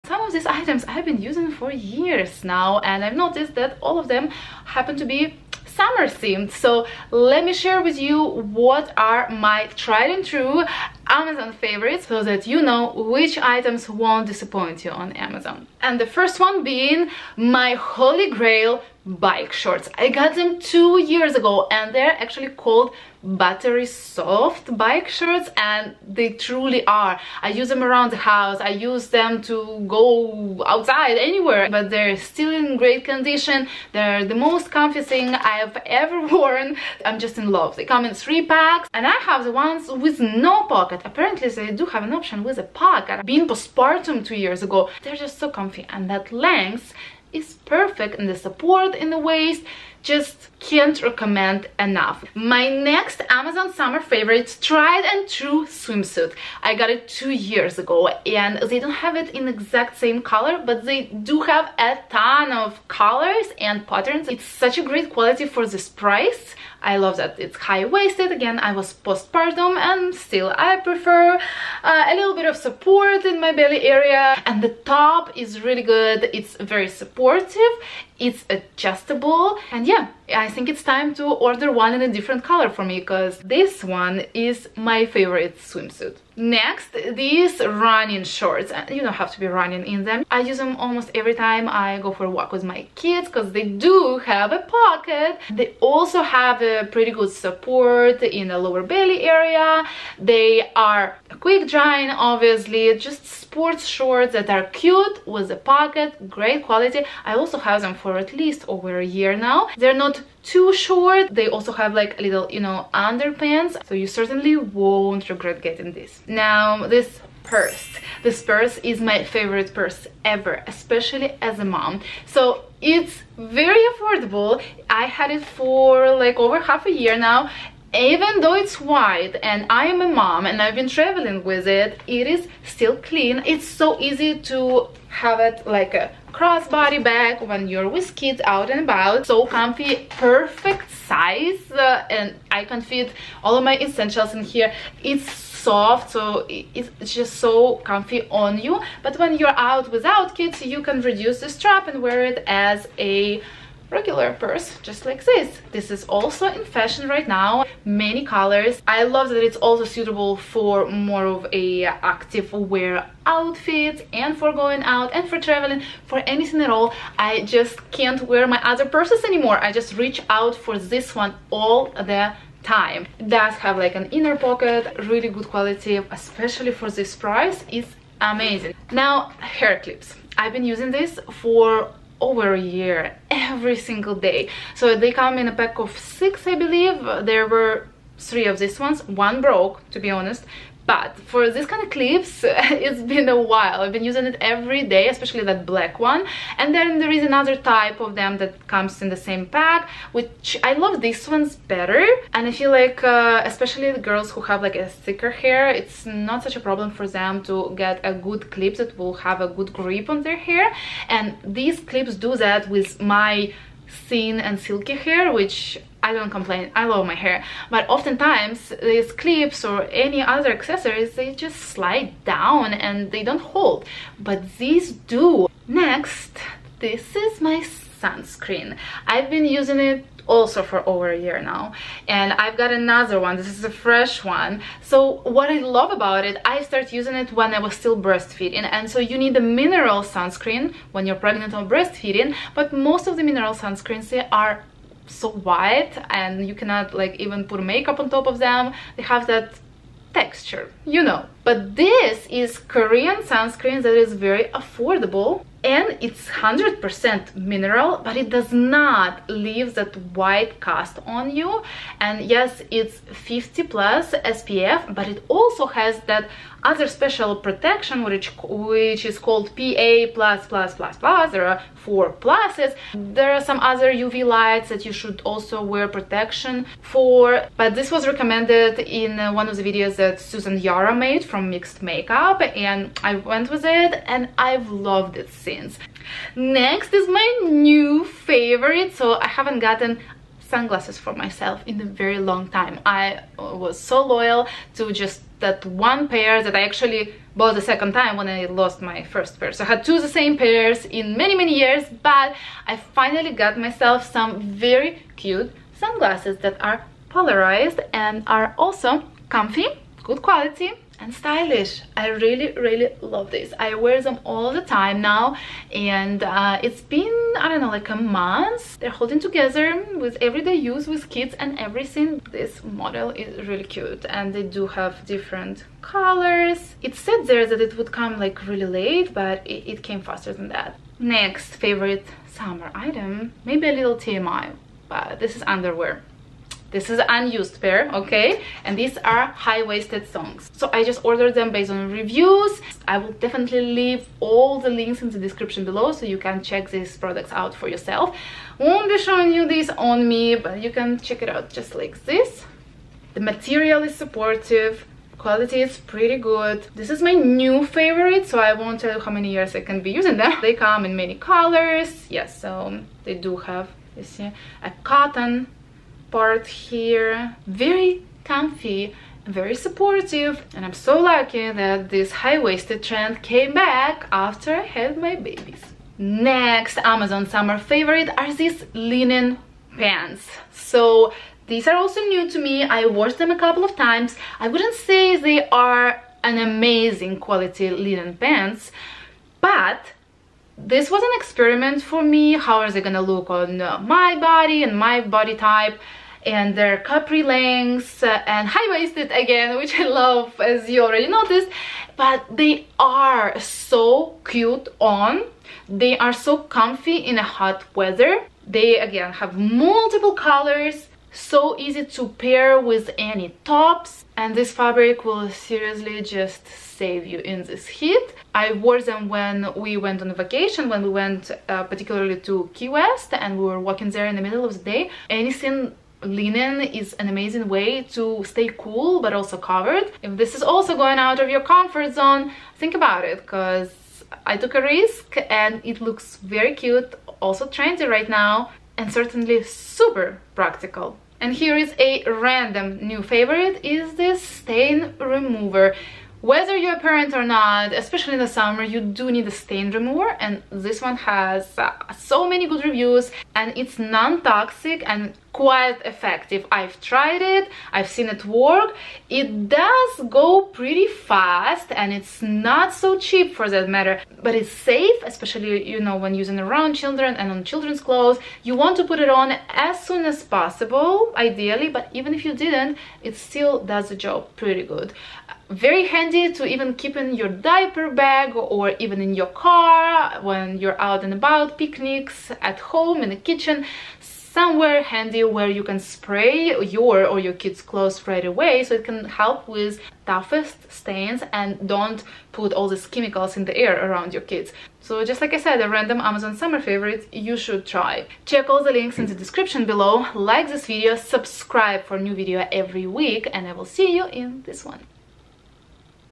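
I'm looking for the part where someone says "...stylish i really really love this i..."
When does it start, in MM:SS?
05:11.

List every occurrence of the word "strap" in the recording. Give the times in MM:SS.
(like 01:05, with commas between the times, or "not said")
02:31.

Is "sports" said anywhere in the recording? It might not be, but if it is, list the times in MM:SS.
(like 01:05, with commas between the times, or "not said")
01:43.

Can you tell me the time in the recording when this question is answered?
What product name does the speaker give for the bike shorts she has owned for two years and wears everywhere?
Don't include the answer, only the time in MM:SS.
00:23.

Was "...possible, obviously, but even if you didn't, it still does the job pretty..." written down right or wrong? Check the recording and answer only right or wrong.
wrong.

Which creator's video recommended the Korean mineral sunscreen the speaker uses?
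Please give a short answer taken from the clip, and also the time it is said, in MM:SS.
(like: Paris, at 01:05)
Susan Yara, at 04:40.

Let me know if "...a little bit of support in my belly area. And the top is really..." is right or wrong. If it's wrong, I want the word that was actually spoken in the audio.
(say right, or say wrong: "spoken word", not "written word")
right.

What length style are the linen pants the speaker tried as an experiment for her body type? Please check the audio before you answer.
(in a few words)
Capri.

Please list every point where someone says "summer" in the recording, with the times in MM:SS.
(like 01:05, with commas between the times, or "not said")
00:05, 00:53, 05:32, 06:17, 07:28, 08:16.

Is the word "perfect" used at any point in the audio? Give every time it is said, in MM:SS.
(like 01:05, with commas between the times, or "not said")
00:47, 02:20.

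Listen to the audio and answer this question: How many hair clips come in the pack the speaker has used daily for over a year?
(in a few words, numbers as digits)
6.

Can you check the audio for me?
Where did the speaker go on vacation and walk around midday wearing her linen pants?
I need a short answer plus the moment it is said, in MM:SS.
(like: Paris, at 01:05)
Key West, at 07:02.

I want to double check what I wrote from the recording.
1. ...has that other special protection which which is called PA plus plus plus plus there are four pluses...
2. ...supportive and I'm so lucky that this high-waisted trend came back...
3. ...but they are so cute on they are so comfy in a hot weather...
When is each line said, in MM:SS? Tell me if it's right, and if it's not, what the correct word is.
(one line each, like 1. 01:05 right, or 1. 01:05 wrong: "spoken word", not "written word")
1. 04:25 right
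2. 06:09 right
3. 06:41 right.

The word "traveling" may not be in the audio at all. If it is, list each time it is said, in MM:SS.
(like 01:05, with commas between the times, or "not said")
02:10, 02:45.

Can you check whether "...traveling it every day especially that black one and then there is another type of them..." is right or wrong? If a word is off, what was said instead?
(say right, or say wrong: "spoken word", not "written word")
wrong: "using", not "traveling".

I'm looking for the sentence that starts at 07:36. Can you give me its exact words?
I've tried it, I've seen it work.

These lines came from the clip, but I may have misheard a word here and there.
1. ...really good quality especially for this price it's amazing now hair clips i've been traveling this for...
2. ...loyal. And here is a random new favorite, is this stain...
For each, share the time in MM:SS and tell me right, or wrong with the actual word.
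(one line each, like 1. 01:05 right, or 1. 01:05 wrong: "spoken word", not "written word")
1. 02:55 wrong: "using", not "traveling"
2. 07:20 wrong: "practical", not "loyal".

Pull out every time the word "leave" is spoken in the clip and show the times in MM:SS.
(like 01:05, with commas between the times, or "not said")
04:19, 05:43.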